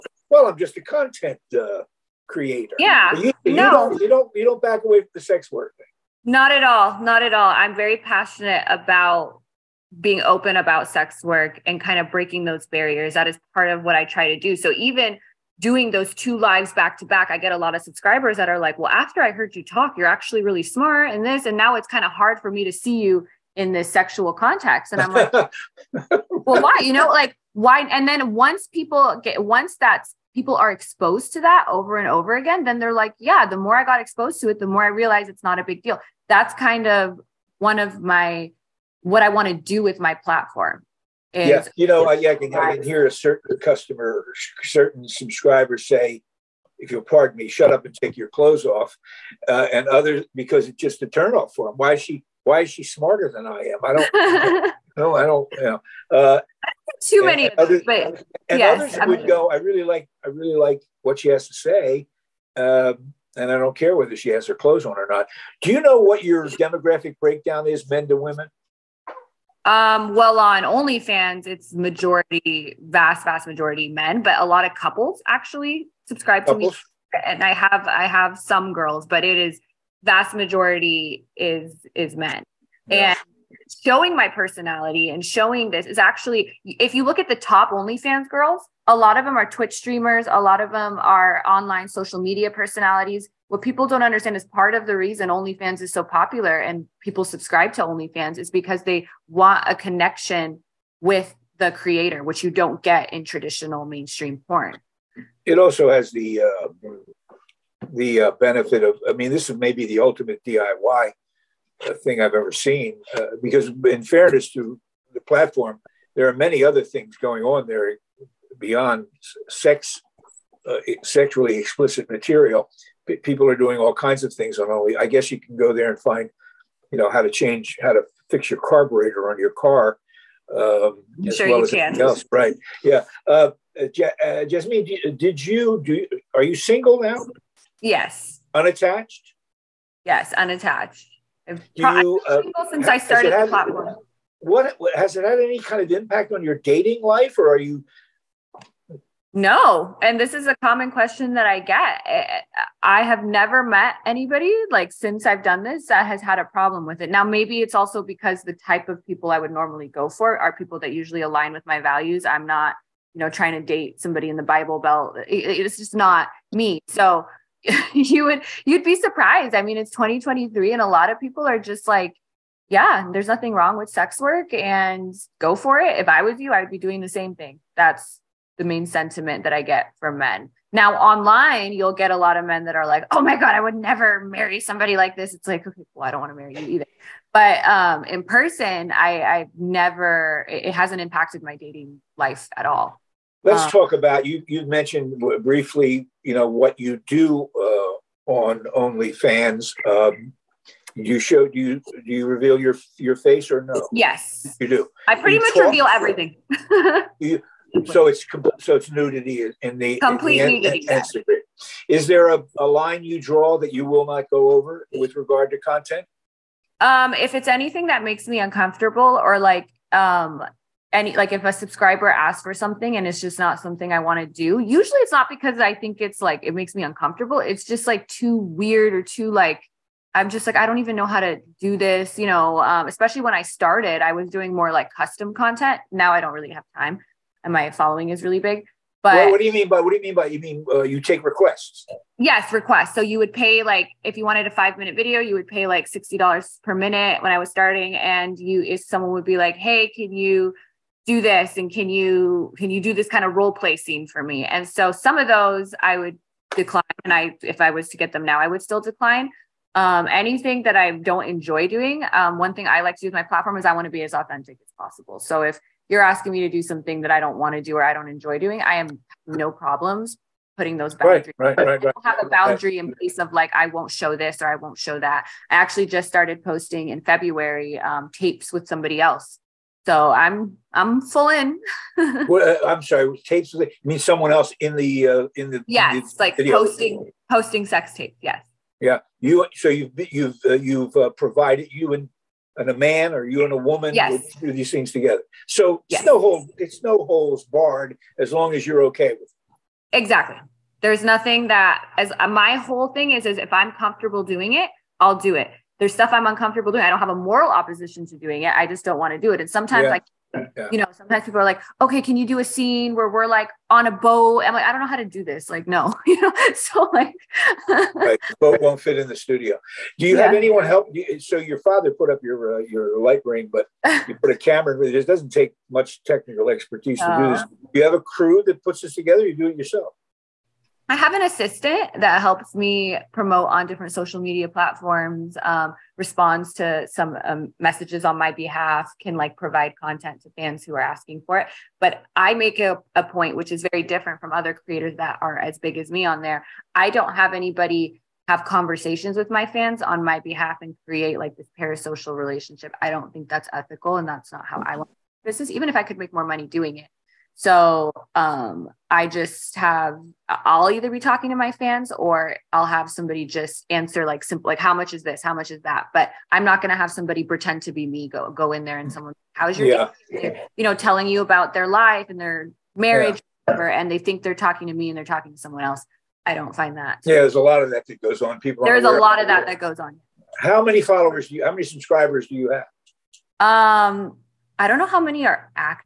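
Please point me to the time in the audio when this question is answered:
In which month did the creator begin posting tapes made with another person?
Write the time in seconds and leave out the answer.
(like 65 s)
277 s.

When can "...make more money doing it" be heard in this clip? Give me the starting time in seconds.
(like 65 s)
355 s.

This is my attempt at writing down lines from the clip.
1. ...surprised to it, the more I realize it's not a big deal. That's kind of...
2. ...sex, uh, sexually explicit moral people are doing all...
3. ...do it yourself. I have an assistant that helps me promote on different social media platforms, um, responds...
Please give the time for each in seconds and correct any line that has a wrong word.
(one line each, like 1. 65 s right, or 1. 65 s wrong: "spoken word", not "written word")
1. 33 s wrong: "exposed", not "surprised"
2. 119 s wrong: "material", not "moral"
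3. 329 s right.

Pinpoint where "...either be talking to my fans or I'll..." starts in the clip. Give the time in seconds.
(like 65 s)
360 s.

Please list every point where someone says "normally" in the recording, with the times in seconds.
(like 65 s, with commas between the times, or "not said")
159 s.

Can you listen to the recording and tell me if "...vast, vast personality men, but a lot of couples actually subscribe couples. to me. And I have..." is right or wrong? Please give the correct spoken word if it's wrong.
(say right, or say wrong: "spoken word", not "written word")
wrong: "majority", not "personality".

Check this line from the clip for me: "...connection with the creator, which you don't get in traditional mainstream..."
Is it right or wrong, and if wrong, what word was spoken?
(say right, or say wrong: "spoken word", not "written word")
right.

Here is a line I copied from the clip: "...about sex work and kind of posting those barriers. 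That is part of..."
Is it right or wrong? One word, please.
wrong.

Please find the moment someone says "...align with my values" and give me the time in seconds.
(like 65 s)
161 s.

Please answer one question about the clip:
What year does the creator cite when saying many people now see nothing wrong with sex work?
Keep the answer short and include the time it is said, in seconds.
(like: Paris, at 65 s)
2023, at 169 s.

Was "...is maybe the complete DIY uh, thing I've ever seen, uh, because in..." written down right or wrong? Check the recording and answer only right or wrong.
wrong.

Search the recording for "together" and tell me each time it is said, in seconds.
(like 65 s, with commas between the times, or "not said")
294 s, 328 s.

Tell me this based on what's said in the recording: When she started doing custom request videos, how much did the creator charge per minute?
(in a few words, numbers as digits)
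$60.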